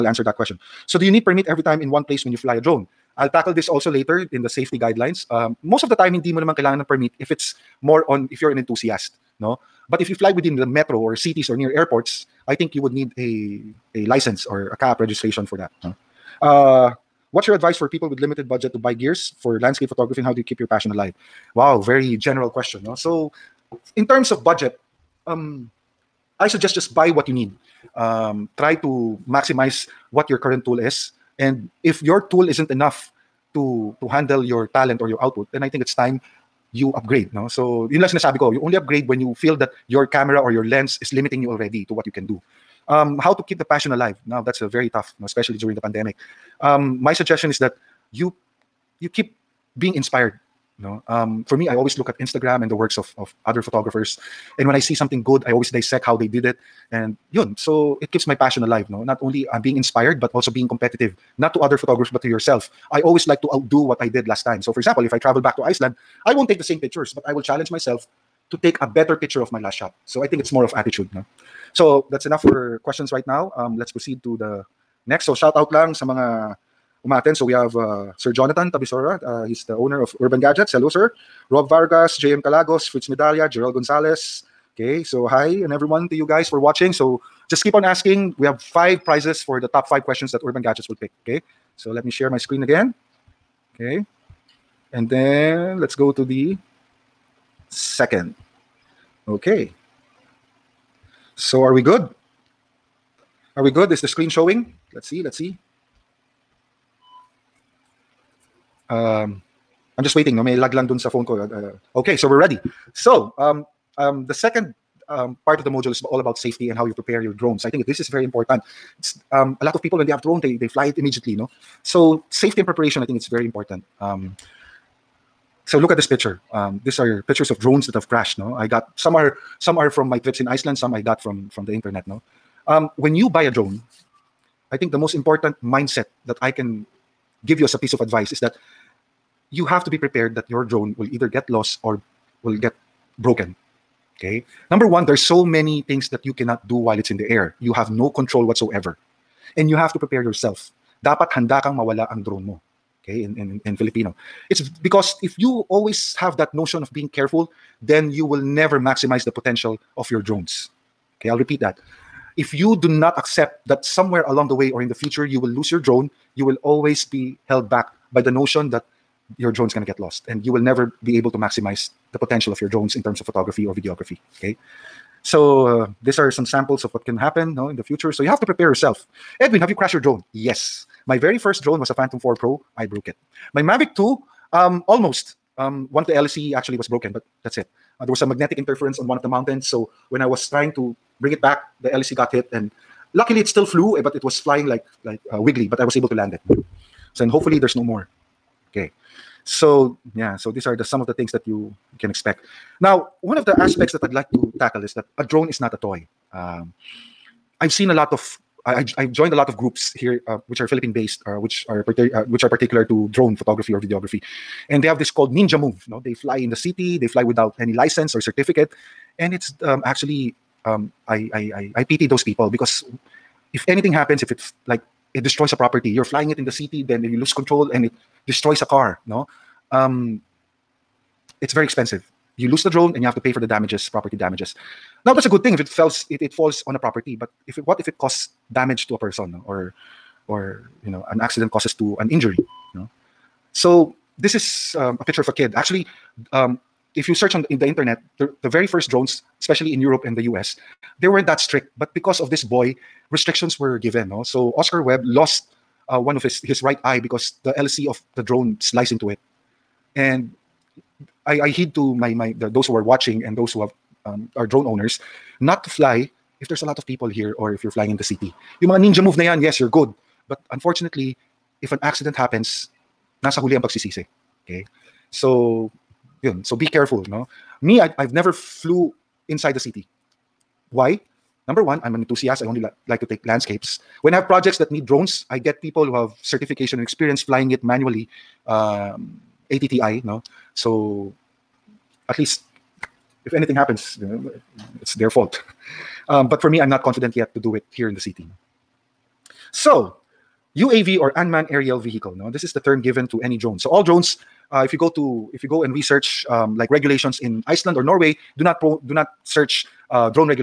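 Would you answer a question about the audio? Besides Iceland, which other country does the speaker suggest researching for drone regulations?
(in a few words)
Norway.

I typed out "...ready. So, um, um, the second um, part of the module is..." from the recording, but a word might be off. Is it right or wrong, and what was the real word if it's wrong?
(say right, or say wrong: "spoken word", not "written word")
right.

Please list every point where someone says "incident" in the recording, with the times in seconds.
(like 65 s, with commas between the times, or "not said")
not said.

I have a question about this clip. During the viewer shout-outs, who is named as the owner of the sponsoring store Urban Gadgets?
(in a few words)
Jonathan Tabisora.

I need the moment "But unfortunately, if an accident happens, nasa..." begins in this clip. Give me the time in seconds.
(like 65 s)
270 s.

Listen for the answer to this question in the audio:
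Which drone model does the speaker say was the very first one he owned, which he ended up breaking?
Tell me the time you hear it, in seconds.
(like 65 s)
181 s.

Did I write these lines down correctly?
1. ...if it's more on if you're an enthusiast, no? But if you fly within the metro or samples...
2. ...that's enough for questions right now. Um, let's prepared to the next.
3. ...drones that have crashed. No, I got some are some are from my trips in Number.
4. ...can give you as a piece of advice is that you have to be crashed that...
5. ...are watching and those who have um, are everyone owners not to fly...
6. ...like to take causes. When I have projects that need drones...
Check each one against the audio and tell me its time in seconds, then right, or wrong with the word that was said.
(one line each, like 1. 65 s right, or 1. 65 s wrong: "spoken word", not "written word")
1. 7 s wrong: "cities", not "samples"
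2. 72 s wrong: "proceed", not "prepared"
3. 127 s wrong: "Iceland", not "Number"
4. 136 s wrong: "prepared", not "crashed"
5. 262 s wrong: "drone", not "everyone"
6. 282 s wrong: "landscapes", not "causes".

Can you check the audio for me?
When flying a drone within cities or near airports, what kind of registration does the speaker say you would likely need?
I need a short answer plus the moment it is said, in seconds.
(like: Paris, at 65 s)
CAAP registration, at 14 s.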